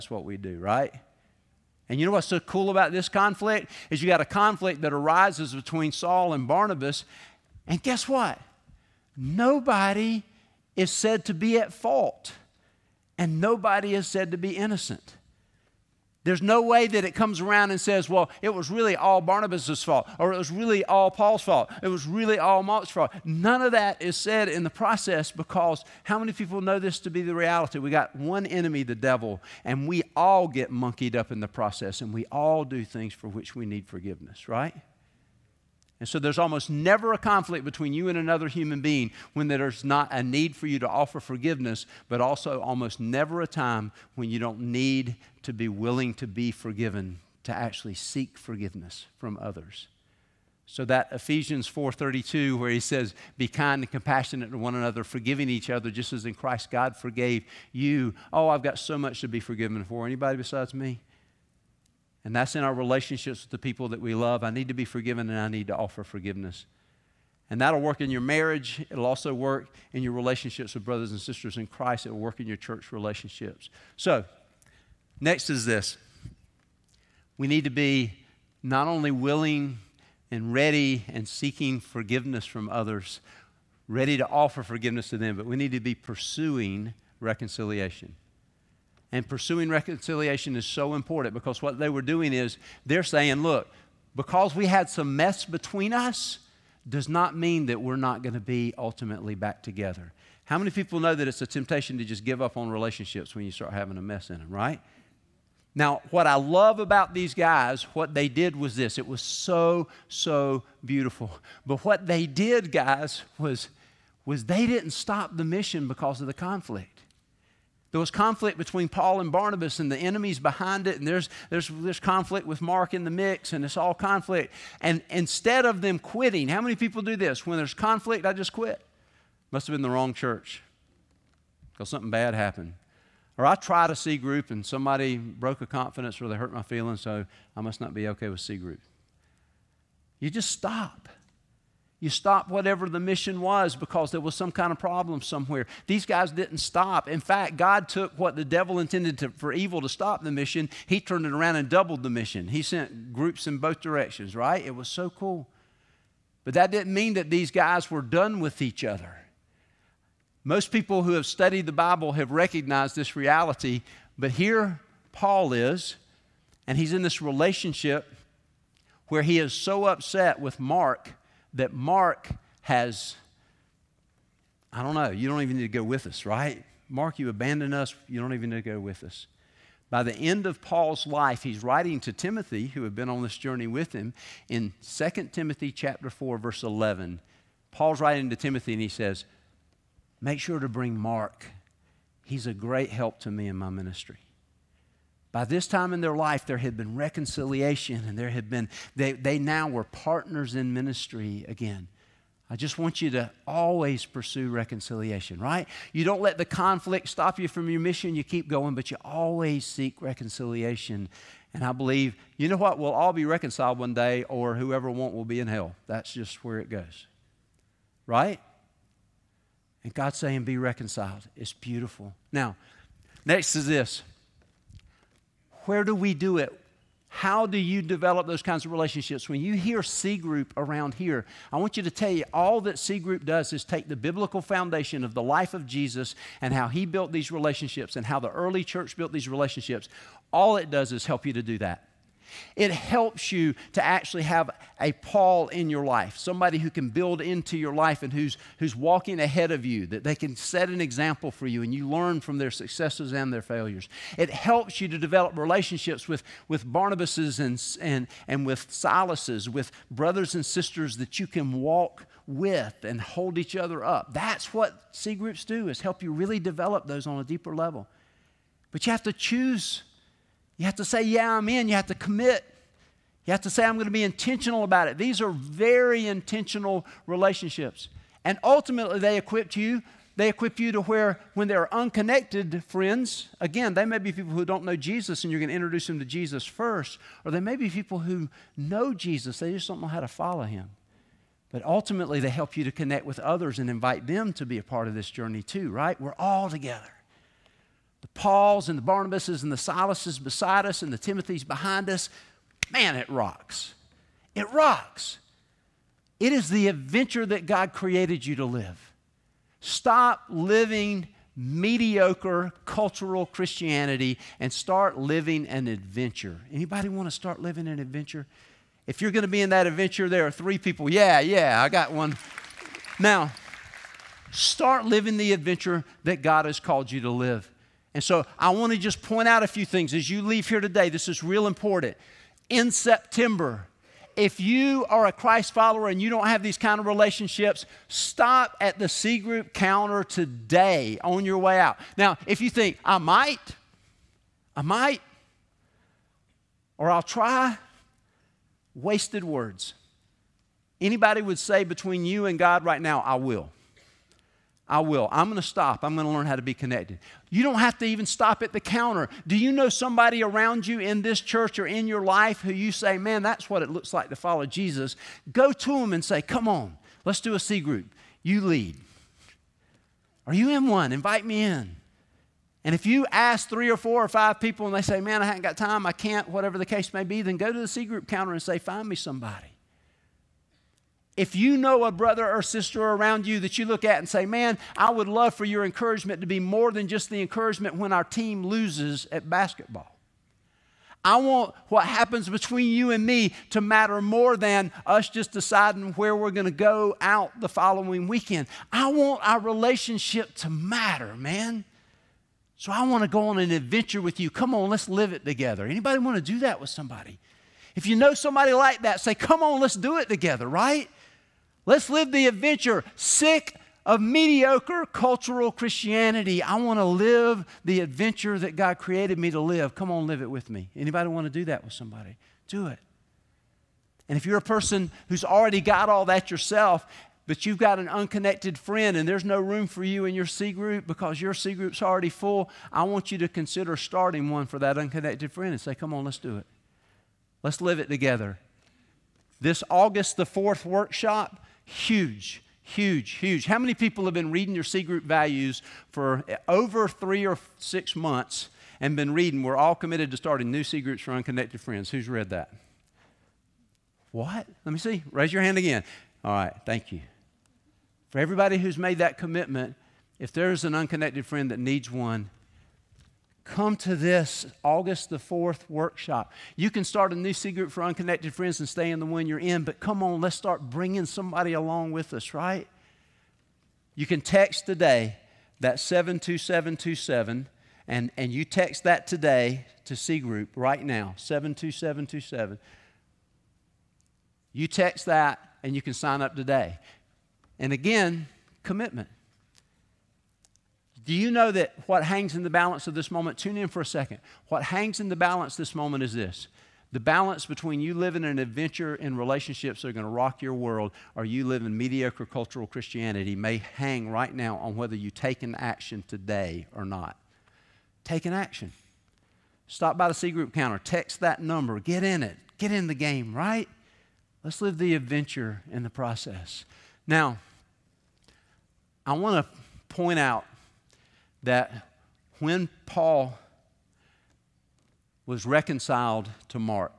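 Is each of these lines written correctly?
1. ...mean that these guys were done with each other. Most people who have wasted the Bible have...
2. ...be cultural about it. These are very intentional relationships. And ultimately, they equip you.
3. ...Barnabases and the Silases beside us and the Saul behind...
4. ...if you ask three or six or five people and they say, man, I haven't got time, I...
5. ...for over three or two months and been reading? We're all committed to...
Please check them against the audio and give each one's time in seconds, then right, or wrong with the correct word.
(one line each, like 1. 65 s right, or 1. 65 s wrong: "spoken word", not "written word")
1. 156 s wrong: "studied", not "wasted"
2. 273 s wrong: "intentional", not "cultural"
3. 298 s wrong: "Timothys", not "Saul"
4. 372 s wrong: "four", not "six"
5. 445 s wrong: "six", not "two".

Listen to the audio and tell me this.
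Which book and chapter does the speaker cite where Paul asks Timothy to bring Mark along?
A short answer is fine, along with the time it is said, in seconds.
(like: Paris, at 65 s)
2 Timothy chapter 4, at 184 s.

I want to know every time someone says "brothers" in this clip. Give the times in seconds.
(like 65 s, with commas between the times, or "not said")
70 s, 259 s, 381 s.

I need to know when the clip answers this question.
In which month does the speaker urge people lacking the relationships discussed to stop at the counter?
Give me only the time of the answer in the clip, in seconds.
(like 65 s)
332 s.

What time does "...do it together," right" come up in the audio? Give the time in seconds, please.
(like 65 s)
409 s.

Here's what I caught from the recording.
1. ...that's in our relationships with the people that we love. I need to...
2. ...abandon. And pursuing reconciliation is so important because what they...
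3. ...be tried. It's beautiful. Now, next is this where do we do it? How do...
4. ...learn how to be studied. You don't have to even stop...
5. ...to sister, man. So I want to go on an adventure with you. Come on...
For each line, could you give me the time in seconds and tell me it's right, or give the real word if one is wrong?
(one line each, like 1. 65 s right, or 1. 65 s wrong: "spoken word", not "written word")
1. 62 s right
2. 87 s wrong: "reconciliation", not "abandon"
3. 220 s wrong: "reconciled", not "tried"
4. 356 s wrong: "connected", not "studied"
5. 400 s wrong: "matter", not "sister".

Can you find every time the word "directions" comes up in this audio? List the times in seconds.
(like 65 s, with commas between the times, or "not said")
153 s.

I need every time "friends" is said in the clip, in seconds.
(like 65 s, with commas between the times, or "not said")
282 s, 428 s, 435 s, 451 s, 461 s, 468 s.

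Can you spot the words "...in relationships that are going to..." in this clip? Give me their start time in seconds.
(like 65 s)
498 s.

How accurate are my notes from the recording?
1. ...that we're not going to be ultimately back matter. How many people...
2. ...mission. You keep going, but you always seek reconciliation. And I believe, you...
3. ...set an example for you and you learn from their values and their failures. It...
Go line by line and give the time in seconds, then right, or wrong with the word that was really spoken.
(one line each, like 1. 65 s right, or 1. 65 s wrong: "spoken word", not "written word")
1. 97 s wrong: "together", not "matter"
2. 207 s right
3. 250 s wrong: "successes", not "values".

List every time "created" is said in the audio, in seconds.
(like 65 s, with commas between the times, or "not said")
307 s, 418 s.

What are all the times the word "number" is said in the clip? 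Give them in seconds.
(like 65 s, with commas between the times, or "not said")
511 s.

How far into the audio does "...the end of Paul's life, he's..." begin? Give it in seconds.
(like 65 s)
180 s.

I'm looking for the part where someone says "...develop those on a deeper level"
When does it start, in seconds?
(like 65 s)
266 s.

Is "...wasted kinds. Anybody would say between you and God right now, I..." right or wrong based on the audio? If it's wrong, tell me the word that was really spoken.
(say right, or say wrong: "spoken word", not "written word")
wrong: "words", not "kinds".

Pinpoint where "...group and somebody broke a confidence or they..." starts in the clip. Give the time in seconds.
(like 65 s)
134 s.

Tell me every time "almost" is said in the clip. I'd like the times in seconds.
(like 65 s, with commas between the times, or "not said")
36 s, 42 s.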